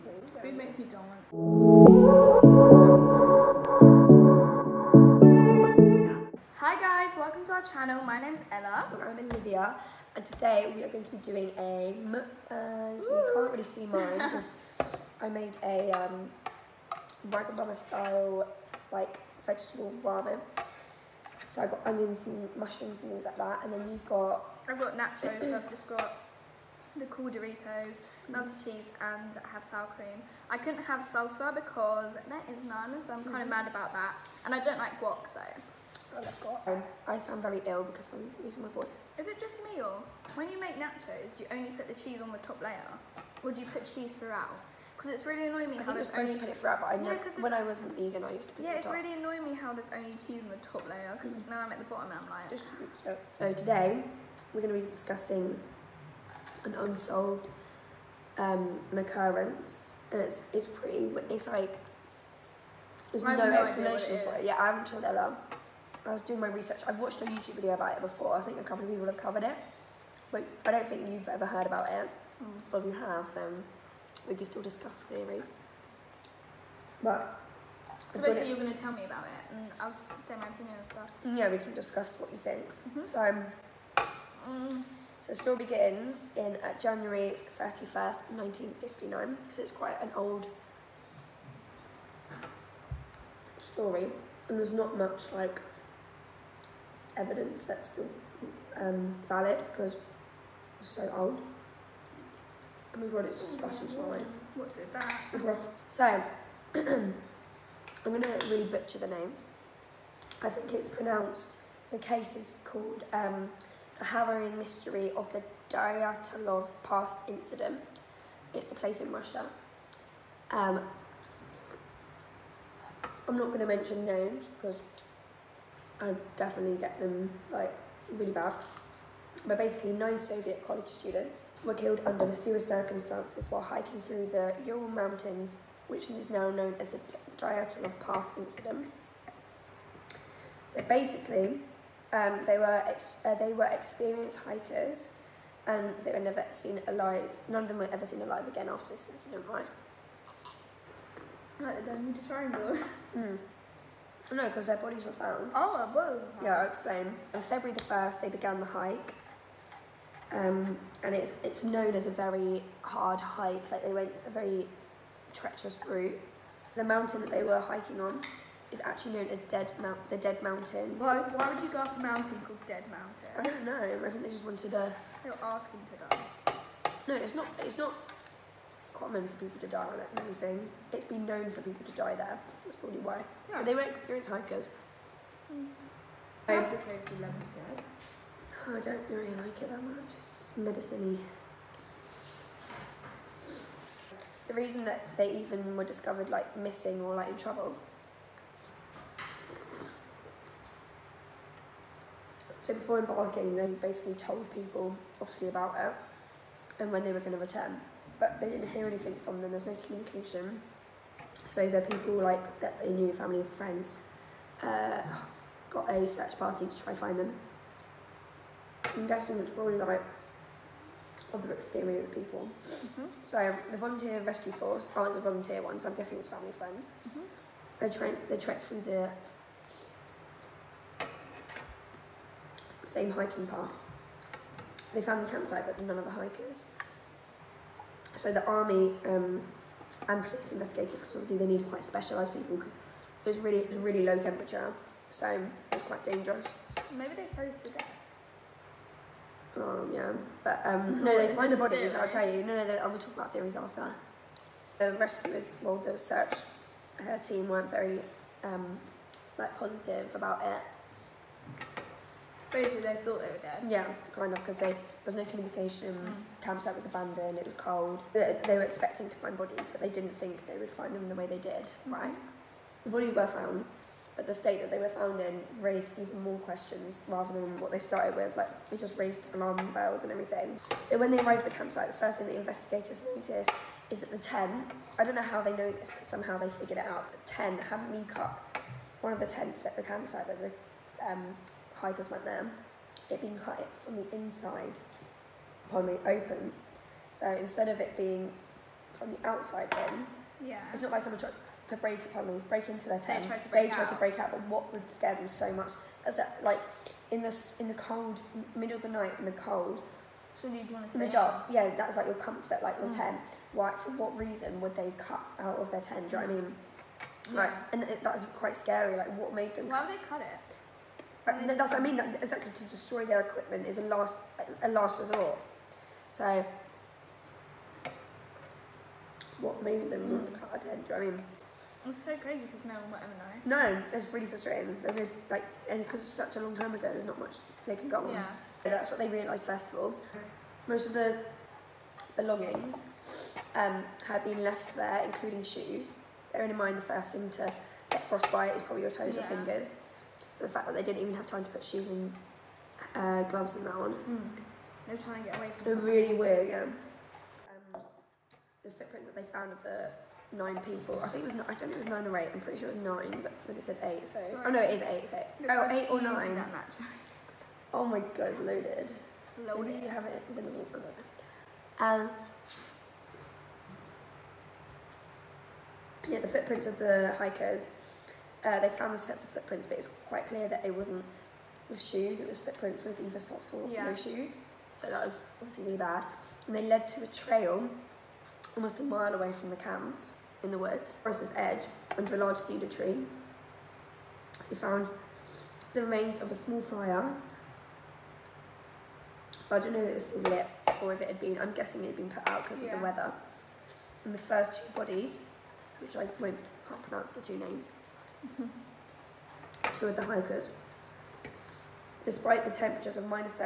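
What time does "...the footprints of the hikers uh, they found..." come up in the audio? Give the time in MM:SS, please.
06:16.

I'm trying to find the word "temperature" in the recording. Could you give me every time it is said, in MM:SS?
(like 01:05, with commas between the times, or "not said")
04:04, 06:52.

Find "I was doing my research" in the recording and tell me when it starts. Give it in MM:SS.
01:06.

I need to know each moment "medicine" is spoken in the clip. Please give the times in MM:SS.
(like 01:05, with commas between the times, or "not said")
03:10.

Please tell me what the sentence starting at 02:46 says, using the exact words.
The mountain that they were hiking on is actually known as Dead Mount, the Dead Mountain.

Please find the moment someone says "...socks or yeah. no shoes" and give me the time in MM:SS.
06:23.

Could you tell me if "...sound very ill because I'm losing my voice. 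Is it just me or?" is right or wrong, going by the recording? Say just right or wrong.
right.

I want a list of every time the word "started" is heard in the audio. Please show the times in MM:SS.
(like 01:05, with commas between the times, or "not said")
04:37.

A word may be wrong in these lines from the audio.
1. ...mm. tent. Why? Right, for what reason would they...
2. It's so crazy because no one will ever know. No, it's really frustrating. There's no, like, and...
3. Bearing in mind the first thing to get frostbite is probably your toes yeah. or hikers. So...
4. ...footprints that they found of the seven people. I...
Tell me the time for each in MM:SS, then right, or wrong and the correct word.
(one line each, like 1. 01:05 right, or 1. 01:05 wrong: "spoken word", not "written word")
1. 05:12 right
2. 05:31 right
3. 05:46 wrong: "fingers", not "hikers"
4. 05:58 wrong: "nine", not "seven".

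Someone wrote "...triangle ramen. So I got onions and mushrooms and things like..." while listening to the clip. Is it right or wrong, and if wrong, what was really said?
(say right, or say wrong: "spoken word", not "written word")
wrong: "vegetable", not "triangle".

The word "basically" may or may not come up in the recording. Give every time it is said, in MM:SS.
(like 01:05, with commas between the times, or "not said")
01:18, 02:09, 02:20, 03:23, 04:22.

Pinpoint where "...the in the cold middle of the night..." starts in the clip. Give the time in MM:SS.
05:07.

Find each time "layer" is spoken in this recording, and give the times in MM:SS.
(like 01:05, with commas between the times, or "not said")
00:42, 00:50.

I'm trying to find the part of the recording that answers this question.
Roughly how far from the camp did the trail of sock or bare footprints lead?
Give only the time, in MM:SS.
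06:28.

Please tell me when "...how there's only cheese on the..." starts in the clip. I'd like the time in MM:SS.
00:49.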